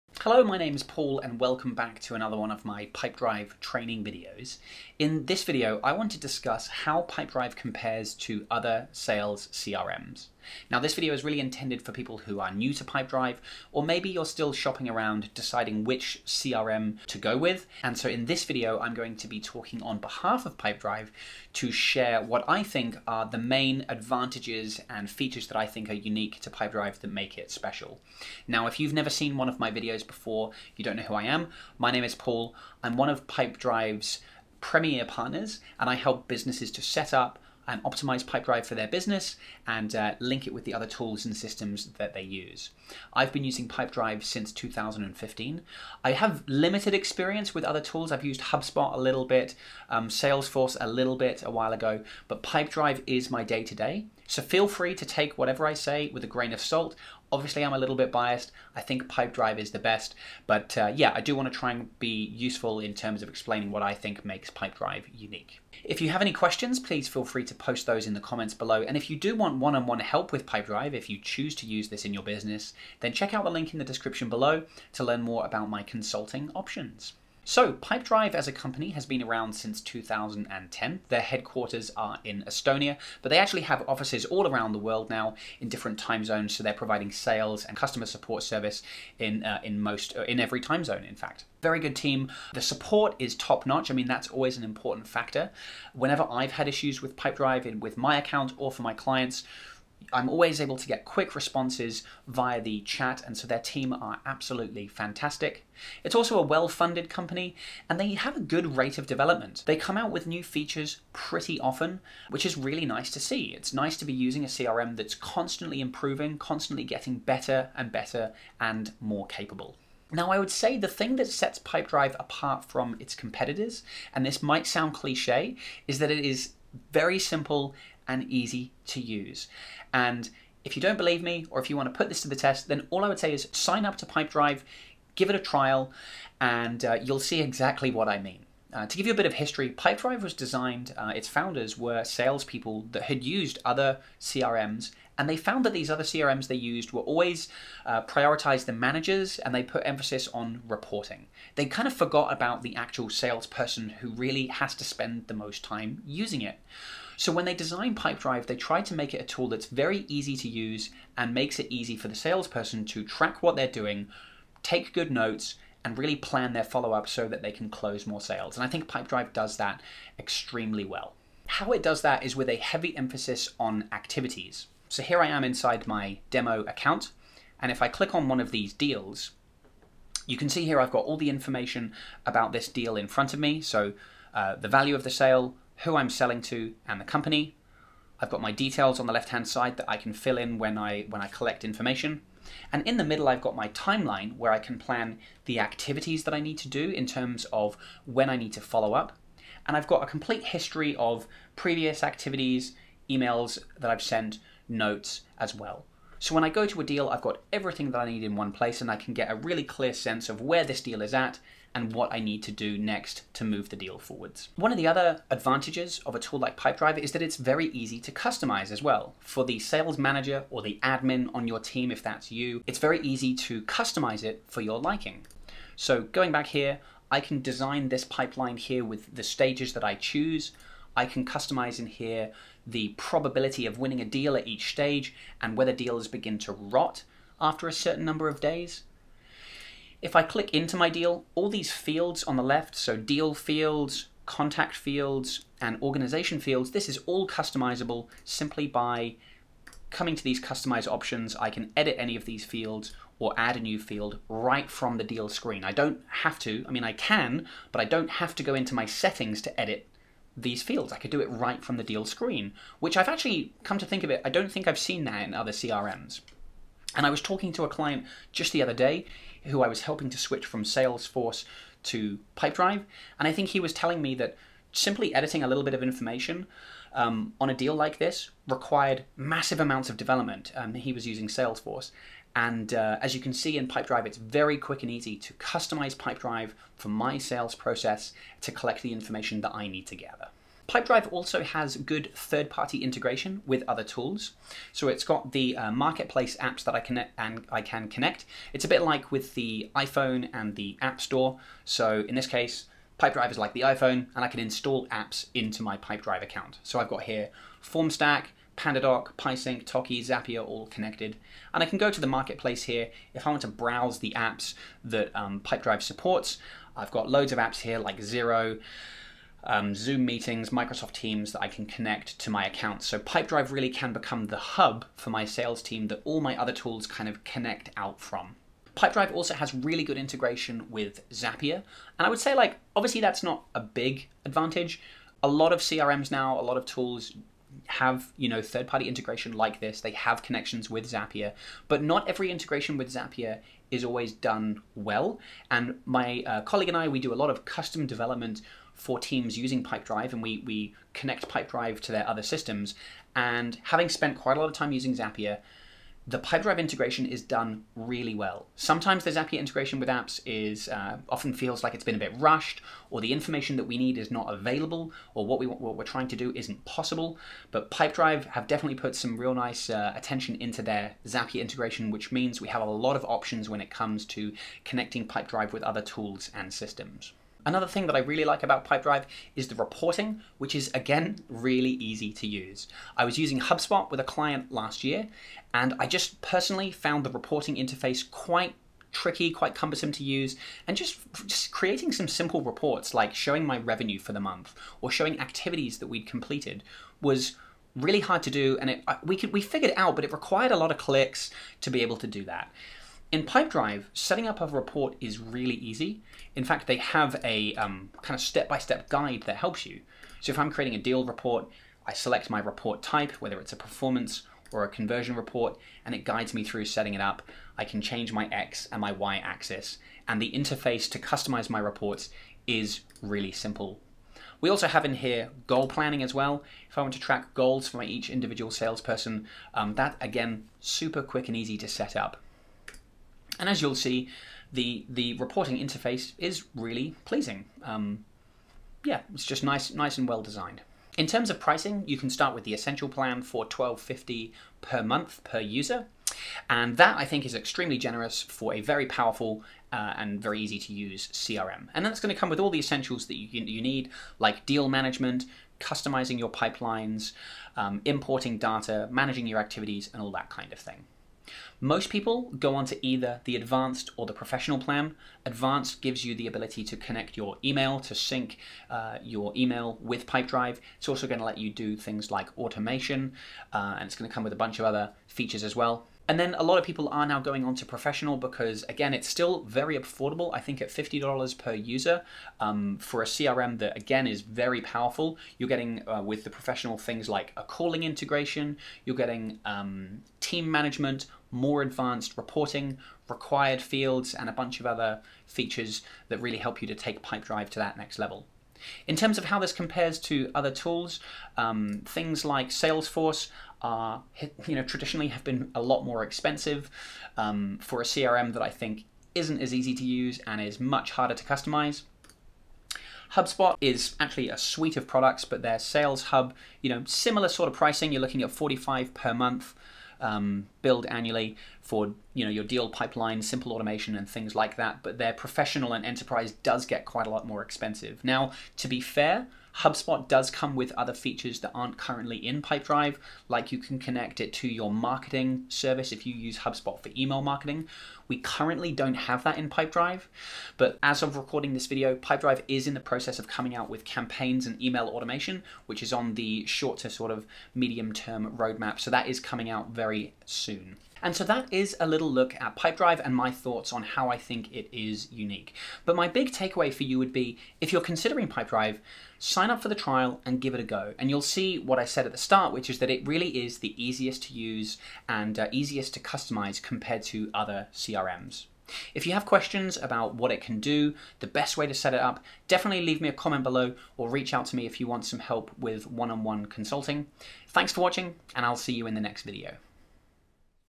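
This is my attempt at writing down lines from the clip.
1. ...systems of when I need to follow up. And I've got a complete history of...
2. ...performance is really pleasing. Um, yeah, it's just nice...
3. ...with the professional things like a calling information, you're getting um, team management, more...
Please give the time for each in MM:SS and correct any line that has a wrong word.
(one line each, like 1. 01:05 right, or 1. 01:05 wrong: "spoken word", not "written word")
1. 03:17 wrong: "terms", not "systems"
2. 07:15 wrong: "interface", not "performance"
3. 08:06 wrong: "integration", not "information".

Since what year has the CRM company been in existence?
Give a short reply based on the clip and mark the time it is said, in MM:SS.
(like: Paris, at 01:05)
2010, at 01:19.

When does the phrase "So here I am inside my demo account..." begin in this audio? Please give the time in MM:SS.
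02:54.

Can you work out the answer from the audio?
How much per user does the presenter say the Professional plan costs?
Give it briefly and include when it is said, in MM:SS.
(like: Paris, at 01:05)
$50, at 08:00.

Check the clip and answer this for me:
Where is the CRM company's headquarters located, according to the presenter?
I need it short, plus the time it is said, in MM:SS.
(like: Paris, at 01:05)
Estonia, at 01:22.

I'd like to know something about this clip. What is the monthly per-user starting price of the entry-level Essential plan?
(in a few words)
12.50.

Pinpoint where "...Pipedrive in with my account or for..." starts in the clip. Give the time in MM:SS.
01:37.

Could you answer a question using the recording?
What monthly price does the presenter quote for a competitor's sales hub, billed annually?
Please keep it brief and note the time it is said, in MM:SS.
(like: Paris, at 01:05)
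45, at 08:38.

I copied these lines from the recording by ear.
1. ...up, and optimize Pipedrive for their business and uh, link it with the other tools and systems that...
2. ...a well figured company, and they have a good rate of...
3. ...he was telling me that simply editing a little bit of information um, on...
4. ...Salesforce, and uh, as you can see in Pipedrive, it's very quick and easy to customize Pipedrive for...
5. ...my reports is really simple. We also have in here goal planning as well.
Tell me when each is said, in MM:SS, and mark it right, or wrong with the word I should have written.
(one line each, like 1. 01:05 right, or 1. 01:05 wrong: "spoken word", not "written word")
1. 00:37 right
2. 01:46 wrong: "funded", not "figured"
3. 04:33 right
4. 04:41 right
5. 07:01 right.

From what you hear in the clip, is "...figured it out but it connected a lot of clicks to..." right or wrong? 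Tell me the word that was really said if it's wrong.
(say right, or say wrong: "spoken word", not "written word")
wrong: "required", not "connected".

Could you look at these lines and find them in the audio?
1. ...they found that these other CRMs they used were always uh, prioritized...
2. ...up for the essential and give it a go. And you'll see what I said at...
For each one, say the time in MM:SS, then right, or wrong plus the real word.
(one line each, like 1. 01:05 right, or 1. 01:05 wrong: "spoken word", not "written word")
1. 02:25 right
2. 09:19 wrong: "trial", not "essential".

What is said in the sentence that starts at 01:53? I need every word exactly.
It's nice to be using a CRM that's constantly improving, constantly getting better and better and more capable.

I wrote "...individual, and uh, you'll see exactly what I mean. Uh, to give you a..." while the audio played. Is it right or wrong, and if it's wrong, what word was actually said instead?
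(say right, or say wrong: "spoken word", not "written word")
wrong: "trial", not "individual".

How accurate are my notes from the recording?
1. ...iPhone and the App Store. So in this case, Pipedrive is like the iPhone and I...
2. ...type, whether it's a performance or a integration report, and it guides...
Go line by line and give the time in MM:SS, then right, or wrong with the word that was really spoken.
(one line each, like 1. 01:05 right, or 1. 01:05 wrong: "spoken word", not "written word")
1. 04:59 right
2. 06:52 wrong: "conversion", not "integration".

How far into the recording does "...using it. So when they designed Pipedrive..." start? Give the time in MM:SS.
02:36.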